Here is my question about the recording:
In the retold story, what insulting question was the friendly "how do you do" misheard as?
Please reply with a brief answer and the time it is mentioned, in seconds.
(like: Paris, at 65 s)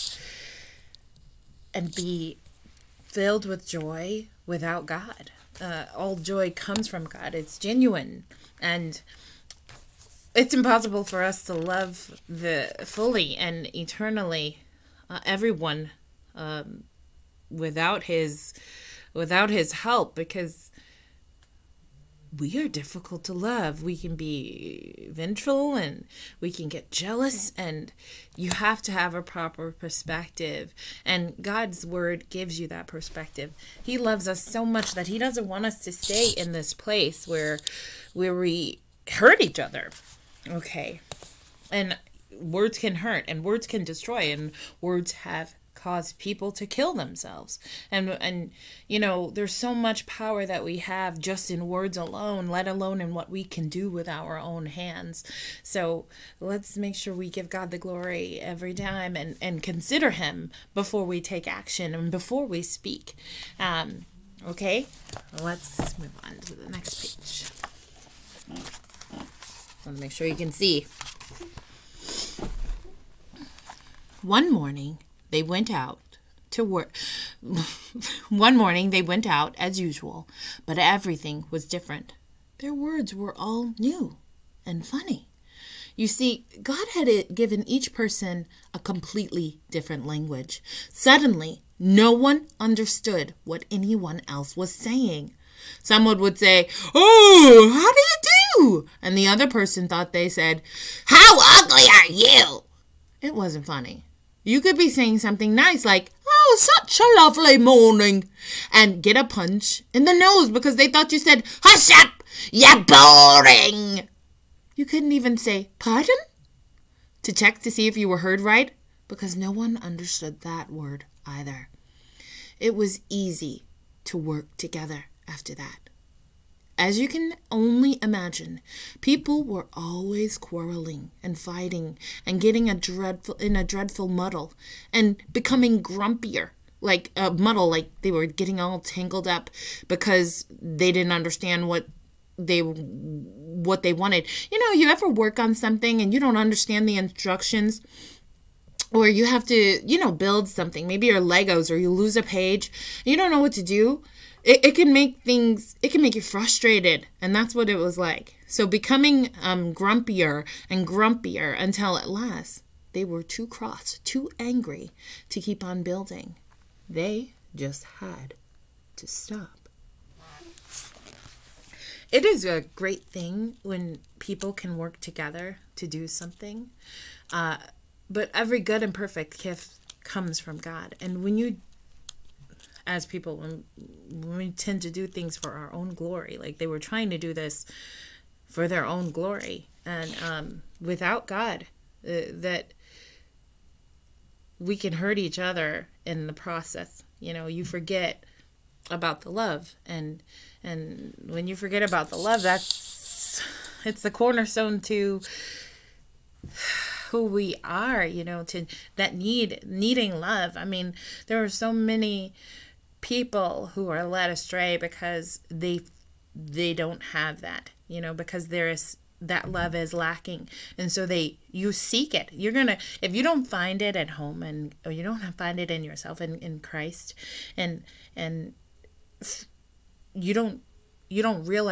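How ugly are you?, at 101 s.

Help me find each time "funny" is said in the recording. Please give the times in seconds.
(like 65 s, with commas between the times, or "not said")
84 s, 103 s.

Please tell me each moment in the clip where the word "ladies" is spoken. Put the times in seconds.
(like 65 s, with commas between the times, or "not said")
not said.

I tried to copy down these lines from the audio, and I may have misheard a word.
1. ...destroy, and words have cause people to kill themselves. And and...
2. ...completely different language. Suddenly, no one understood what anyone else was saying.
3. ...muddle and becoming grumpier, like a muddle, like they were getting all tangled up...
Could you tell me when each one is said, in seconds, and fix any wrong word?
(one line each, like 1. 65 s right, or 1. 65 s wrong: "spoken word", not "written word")
1. 43 s right
2. 88 s right
3. 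134 s right.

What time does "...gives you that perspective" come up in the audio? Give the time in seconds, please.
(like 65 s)
32 s.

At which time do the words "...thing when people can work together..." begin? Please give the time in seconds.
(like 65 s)
173 s.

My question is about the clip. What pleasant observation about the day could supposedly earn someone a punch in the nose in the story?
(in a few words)
Such a lovely morning.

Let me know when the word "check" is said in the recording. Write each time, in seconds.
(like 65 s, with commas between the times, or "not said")
117 s.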